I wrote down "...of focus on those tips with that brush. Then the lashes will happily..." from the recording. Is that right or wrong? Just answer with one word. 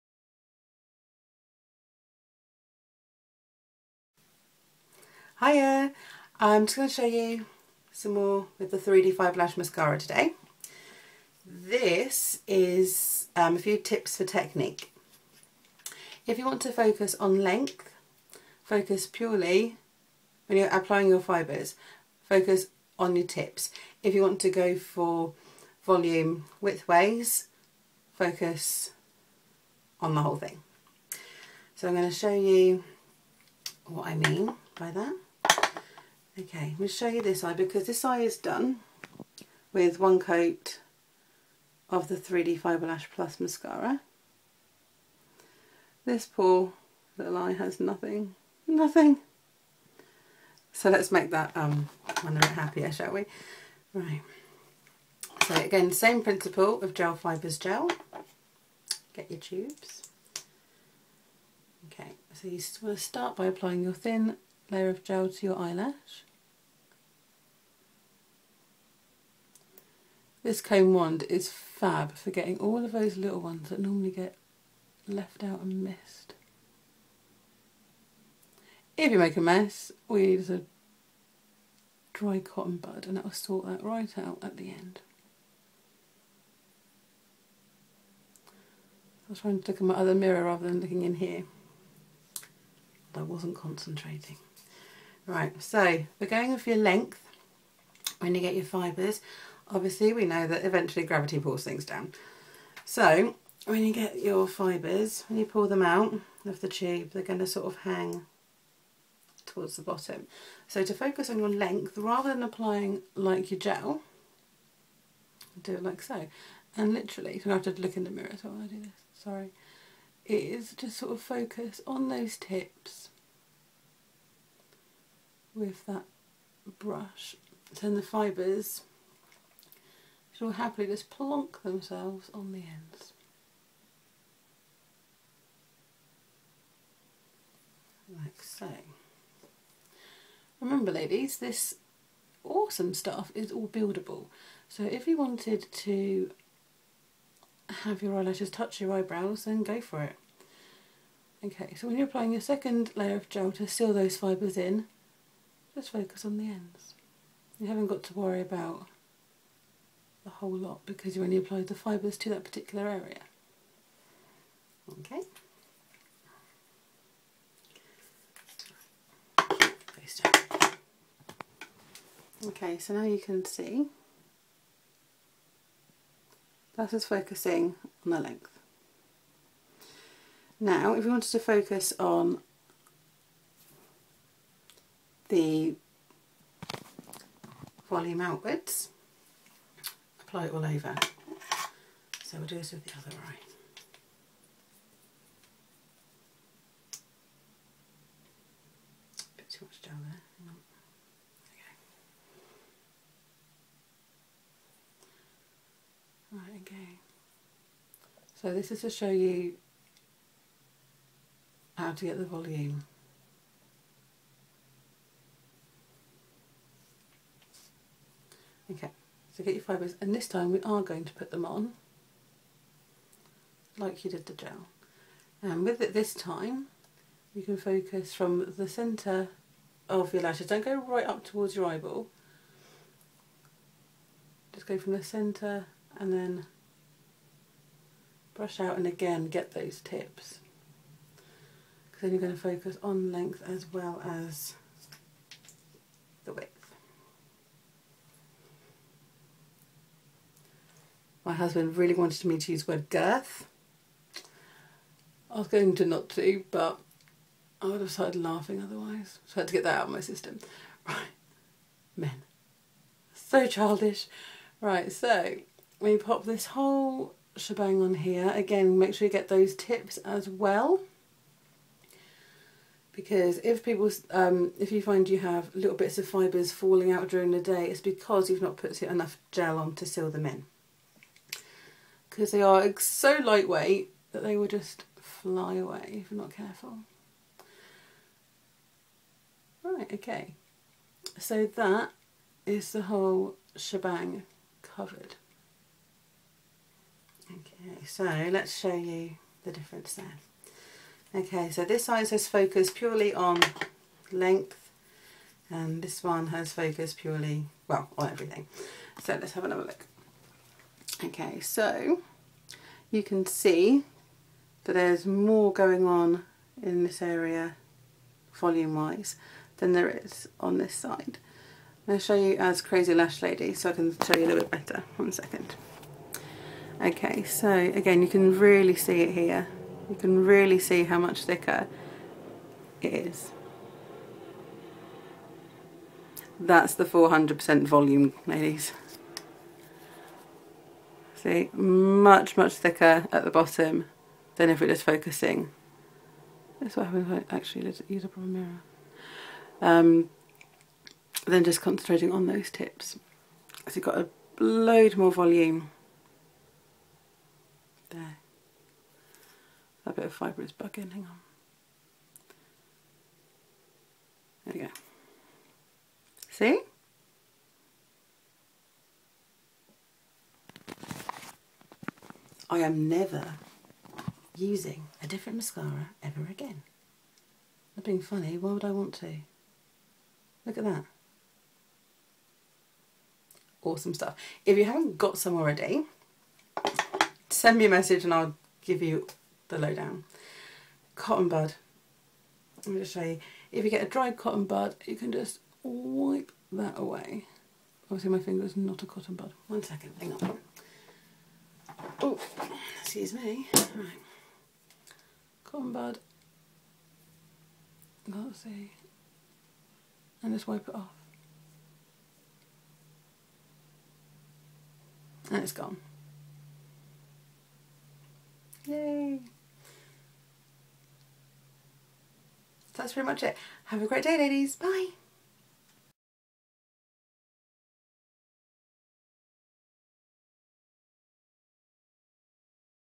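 wrong.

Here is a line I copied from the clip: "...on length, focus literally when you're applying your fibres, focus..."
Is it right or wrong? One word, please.
wrong.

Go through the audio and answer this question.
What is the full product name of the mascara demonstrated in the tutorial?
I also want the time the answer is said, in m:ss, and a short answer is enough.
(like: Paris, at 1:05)
3D Fibre Lash Mascara, at 0:08.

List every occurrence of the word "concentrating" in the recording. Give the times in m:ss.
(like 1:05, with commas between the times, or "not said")
1:33, 5:51.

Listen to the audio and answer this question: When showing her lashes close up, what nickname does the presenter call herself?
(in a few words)
Crazy Lash Lady.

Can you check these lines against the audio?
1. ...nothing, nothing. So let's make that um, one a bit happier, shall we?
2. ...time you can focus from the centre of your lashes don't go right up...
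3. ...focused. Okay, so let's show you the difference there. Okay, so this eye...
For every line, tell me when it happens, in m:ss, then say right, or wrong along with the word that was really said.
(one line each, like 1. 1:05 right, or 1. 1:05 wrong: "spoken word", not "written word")
1. 0:47 right
2. 3:46 right
3. 4:54 wrong: "covered", not "focused".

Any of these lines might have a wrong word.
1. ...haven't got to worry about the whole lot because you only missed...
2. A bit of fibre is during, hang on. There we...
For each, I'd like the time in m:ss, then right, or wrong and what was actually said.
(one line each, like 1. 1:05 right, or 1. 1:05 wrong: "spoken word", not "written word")
1. 2:37 wrong: "applied", not "missed"
2. 5:59 wrong: "bugging", not "during".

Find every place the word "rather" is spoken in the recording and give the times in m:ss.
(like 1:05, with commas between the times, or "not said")
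1:30, 1:51.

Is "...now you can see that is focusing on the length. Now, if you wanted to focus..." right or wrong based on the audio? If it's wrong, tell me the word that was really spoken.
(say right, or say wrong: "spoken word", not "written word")
right.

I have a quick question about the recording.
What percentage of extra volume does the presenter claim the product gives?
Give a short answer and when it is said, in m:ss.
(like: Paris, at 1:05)
400%, at 5:36.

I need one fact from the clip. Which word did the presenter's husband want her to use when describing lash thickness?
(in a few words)
girth.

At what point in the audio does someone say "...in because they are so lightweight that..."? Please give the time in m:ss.
4:40.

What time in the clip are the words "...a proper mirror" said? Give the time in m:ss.
5:48.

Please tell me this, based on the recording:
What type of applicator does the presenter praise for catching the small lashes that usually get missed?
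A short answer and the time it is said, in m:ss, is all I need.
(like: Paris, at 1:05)
comb wand, at 1:10.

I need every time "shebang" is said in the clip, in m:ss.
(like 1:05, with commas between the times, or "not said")
4:27, 4:53.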